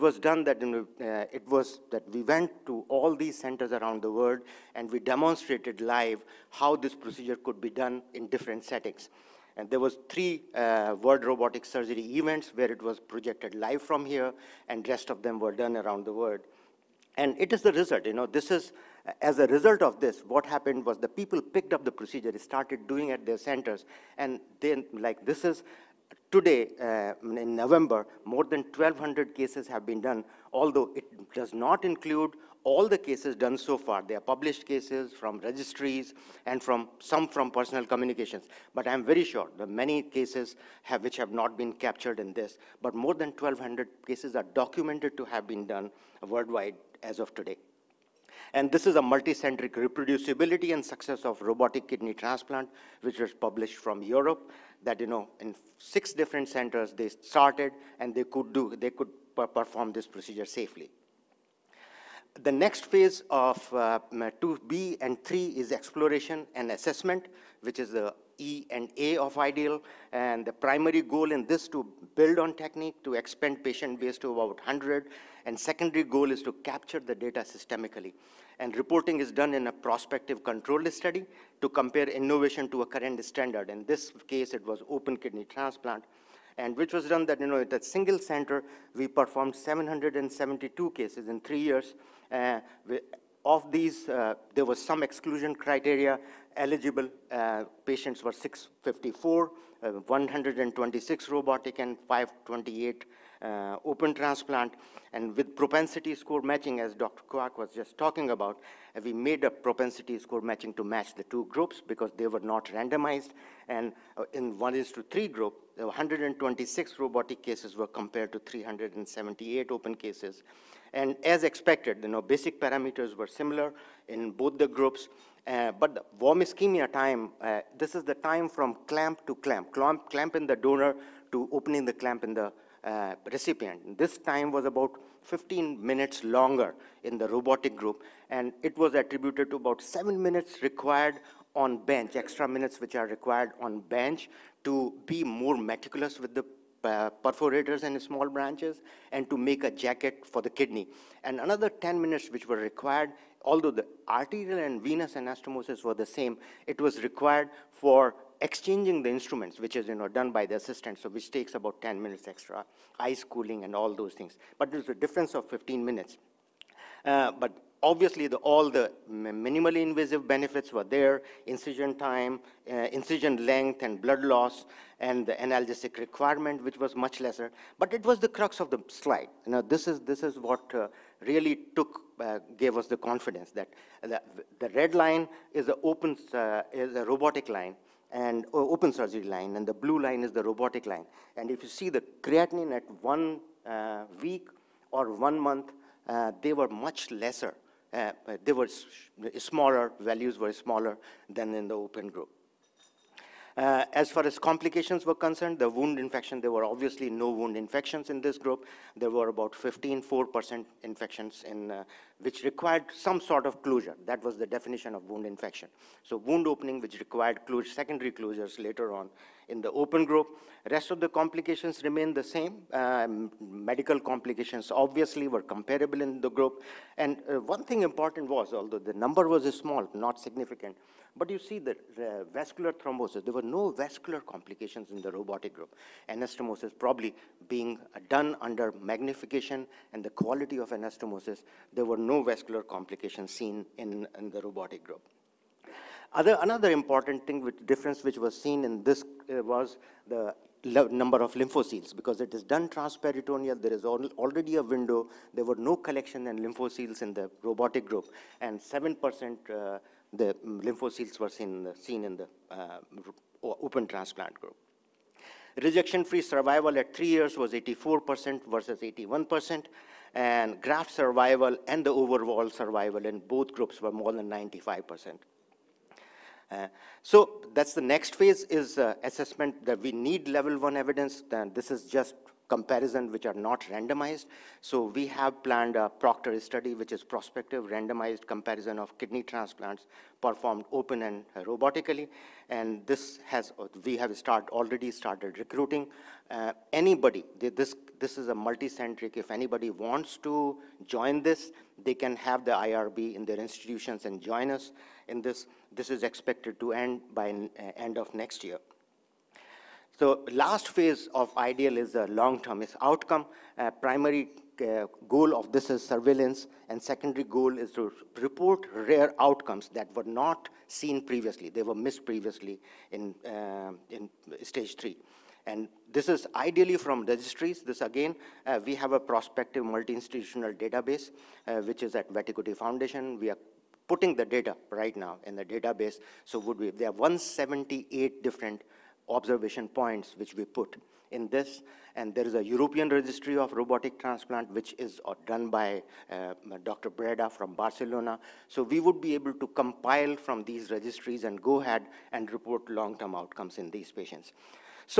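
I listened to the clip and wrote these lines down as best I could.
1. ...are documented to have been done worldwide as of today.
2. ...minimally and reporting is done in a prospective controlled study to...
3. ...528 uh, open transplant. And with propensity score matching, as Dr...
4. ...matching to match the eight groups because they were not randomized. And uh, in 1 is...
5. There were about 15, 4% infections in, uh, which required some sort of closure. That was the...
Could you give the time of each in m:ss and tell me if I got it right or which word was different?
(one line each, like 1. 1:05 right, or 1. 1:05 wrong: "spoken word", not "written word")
1. 0:44 right
2. 1:17 wrong: "systemically", not "minimally"
3. 1:42 right
4. 1:50 wrong: "two", not "eight"
5. 3:28 right.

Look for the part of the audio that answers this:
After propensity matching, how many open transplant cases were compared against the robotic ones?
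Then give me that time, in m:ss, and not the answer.
1:58.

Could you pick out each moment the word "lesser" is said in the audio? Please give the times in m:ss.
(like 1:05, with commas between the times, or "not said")
2:57, 3:17.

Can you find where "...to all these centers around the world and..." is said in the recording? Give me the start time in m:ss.
0:02.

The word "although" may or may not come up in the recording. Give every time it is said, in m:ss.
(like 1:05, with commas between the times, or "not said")
0:30, 2:33, 3:48.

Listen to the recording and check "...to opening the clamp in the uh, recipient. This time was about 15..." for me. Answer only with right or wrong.
right.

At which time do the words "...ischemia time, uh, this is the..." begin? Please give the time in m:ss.
2:06.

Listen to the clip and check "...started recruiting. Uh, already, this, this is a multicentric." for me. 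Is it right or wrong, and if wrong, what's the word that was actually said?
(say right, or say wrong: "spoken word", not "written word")
wrong: "anybody", not "already".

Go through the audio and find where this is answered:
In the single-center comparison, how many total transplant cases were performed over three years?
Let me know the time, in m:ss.
1:29.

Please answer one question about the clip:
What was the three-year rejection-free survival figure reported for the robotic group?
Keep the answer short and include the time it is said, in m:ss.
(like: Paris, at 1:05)
84%, at 4:27.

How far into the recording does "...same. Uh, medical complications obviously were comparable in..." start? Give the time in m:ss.
3:42.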